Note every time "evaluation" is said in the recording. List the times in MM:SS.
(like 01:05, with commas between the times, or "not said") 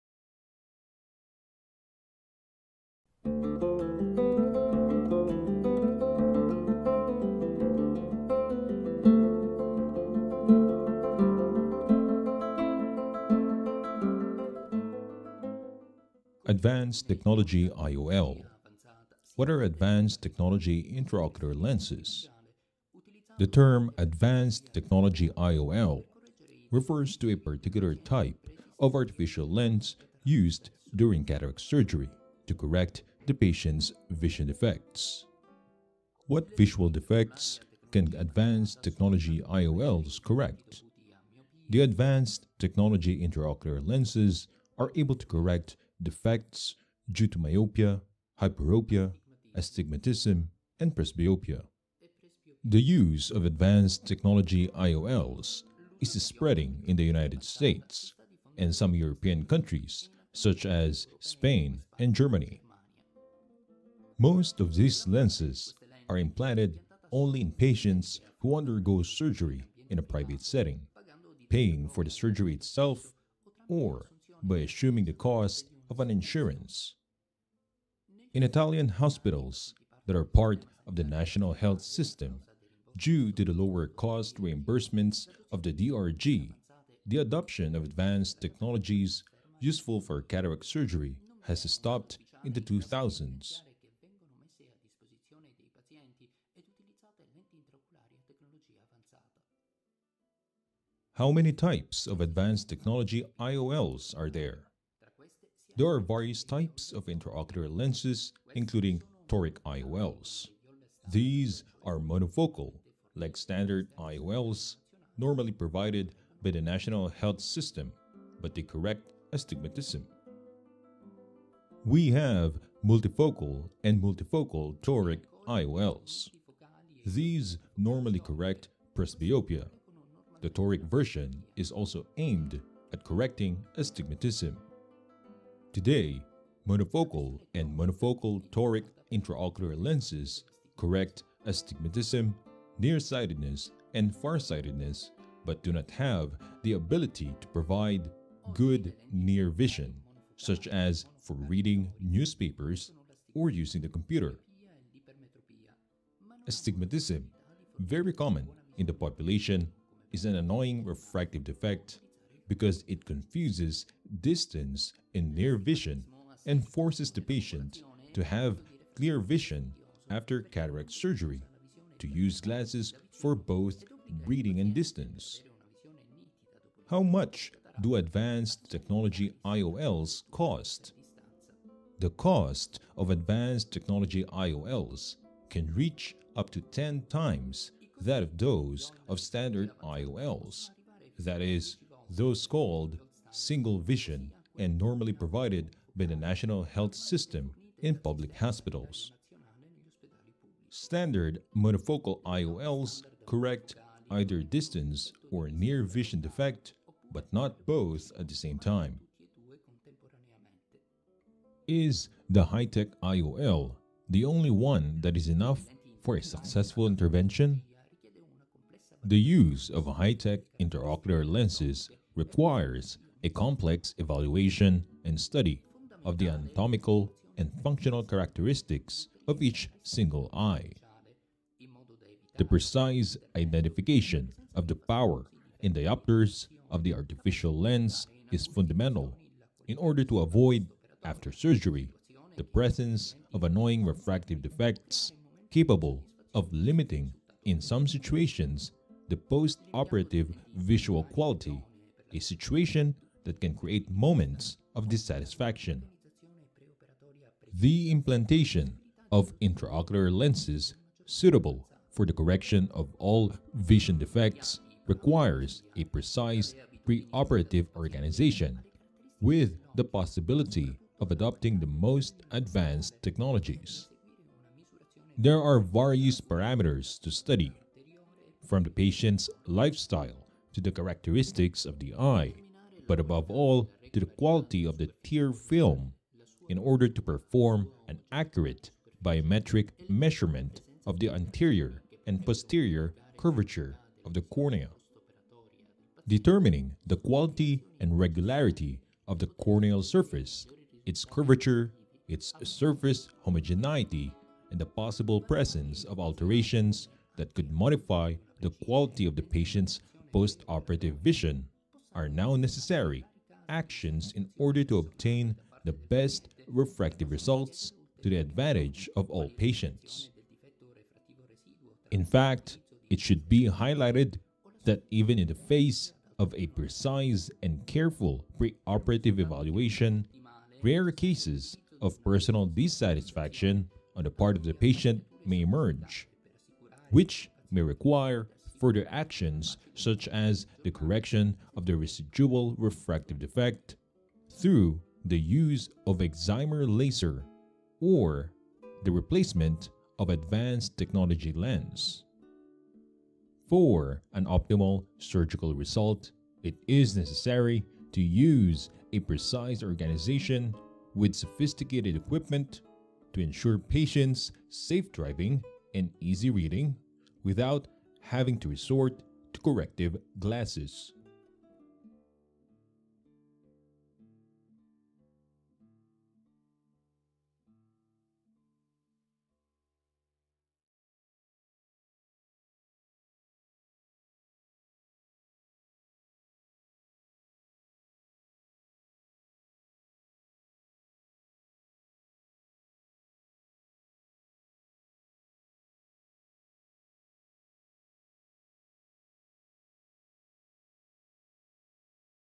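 03:43, 05:29.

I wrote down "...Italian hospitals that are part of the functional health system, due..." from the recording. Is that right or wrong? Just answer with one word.
wrong.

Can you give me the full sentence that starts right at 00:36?
What visual defects can advanced technology IOLs correct?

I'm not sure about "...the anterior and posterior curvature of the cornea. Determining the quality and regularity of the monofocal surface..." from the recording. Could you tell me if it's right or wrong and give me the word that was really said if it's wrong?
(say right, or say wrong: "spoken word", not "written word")
wrong: "corneal", not "monofocal".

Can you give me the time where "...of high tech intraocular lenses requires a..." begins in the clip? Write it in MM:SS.
03:39.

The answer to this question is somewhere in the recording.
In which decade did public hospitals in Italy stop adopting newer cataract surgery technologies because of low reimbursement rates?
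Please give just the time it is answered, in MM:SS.
01:32.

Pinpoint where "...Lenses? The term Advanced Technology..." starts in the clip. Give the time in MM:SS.
00:21.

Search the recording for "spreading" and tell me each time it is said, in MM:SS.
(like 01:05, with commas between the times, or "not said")
00:56.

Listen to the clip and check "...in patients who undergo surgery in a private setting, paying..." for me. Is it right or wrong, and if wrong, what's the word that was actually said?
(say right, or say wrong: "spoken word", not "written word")
right.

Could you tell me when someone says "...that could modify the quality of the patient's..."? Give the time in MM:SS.
05:07.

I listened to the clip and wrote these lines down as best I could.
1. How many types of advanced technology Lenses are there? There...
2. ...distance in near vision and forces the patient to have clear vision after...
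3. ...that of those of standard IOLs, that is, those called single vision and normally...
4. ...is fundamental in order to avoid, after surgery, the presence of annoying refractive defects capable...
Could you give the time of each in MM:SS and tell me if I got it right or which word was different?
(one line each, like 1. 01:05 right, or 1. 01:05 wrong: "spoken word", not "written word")
1. 01:41 wrong: "IOLs", not "Lenses"
2. 02:44 right
3. 03:08 right
4. 03:58 right.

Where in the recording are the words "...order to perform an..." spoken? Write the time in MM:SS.
04:46.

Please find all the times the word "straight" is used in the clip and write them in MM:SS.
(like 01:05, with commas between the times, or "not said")
not said.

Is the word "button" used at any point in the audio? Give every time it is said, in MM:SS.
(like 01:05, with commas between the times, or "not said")
not said.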